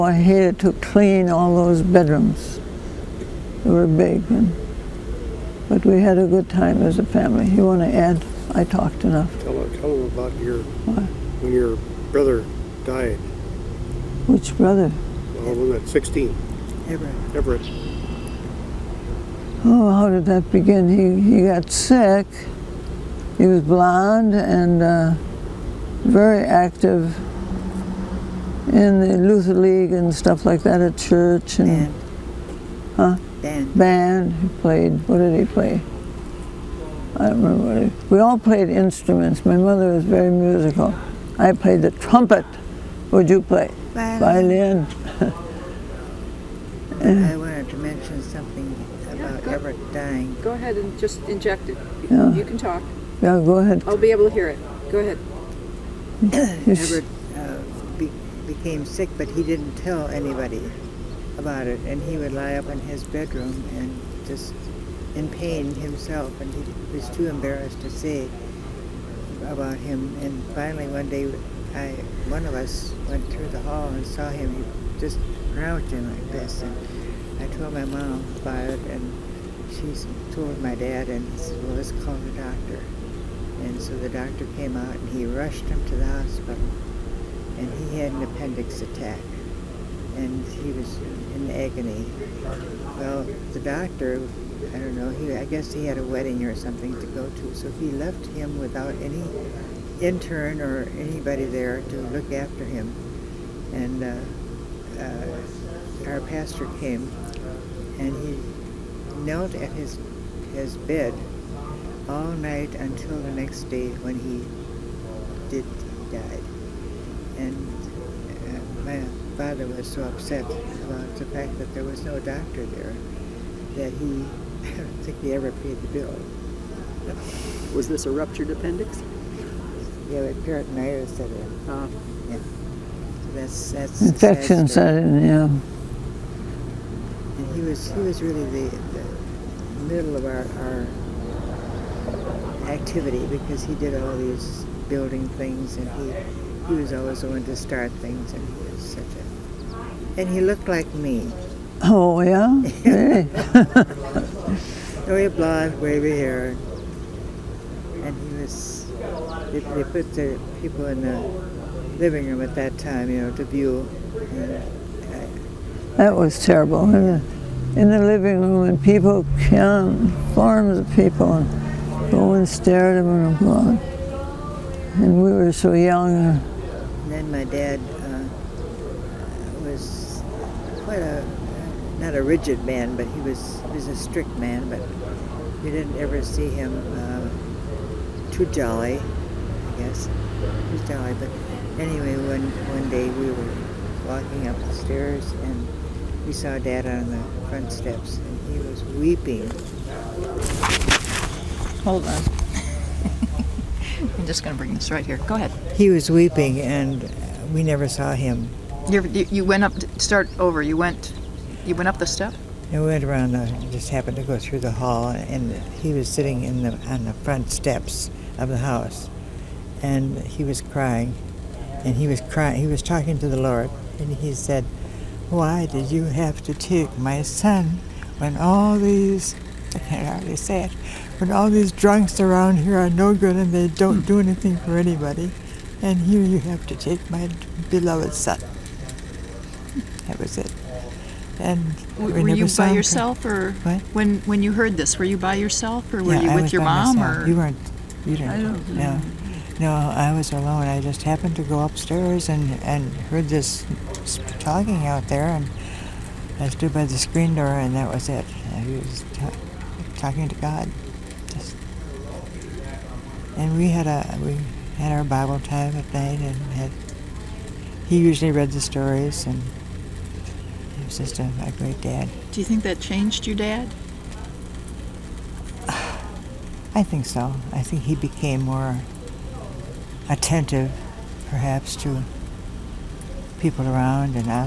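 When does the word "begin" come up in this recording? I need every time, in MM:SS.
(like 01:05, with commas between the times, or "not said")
00:20.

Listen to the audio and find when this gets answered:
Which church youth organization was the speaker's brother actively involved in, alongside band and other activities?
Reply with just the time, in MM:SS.
00:29.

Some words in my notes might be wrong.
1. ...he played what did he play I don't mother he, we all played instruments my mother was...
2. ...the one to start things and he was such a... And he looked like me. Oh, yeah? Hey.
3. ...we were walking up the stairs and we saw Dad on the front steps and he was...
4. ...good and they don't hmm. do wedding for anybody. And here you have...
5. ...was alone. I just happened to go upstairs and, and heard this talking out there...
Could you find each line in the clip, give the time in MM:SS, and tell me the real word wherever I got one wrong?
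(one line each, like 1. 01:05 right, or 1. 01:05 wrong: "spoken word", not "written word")
1. 00:34 wrong: "remember", not "mother"
2. 02:27 right
3. 03:13 right
4. 03:53 wrong: "anything", not "wedding"
5. 04:10 right.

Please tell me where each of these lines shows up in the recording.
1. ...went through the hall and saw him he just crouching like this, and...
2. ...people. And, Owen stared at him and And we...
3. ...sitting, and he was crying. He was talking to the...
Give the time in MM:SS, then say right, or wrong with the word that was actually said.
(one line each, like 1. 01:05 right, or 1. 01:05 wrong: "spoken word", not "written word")
1. 01:13 right
2. 02:50 right
3. 03:40 wrong: "crying", not "sitting".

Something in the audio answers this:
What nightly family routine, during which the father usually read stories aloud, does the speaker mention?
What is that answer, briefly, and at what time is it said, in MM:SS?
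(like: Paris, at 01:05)
Bible time, at 04:25.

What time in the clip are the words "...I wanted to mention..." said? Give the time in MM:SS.
00:47.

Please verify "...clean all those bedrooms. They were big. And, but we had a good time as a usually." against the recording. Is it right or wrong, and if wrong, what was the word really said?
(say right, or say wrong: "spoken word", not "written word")
wrong: "family", not "usually".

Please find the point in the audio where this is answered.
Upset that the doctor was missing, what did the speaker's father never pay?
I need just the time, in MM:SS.
02:05.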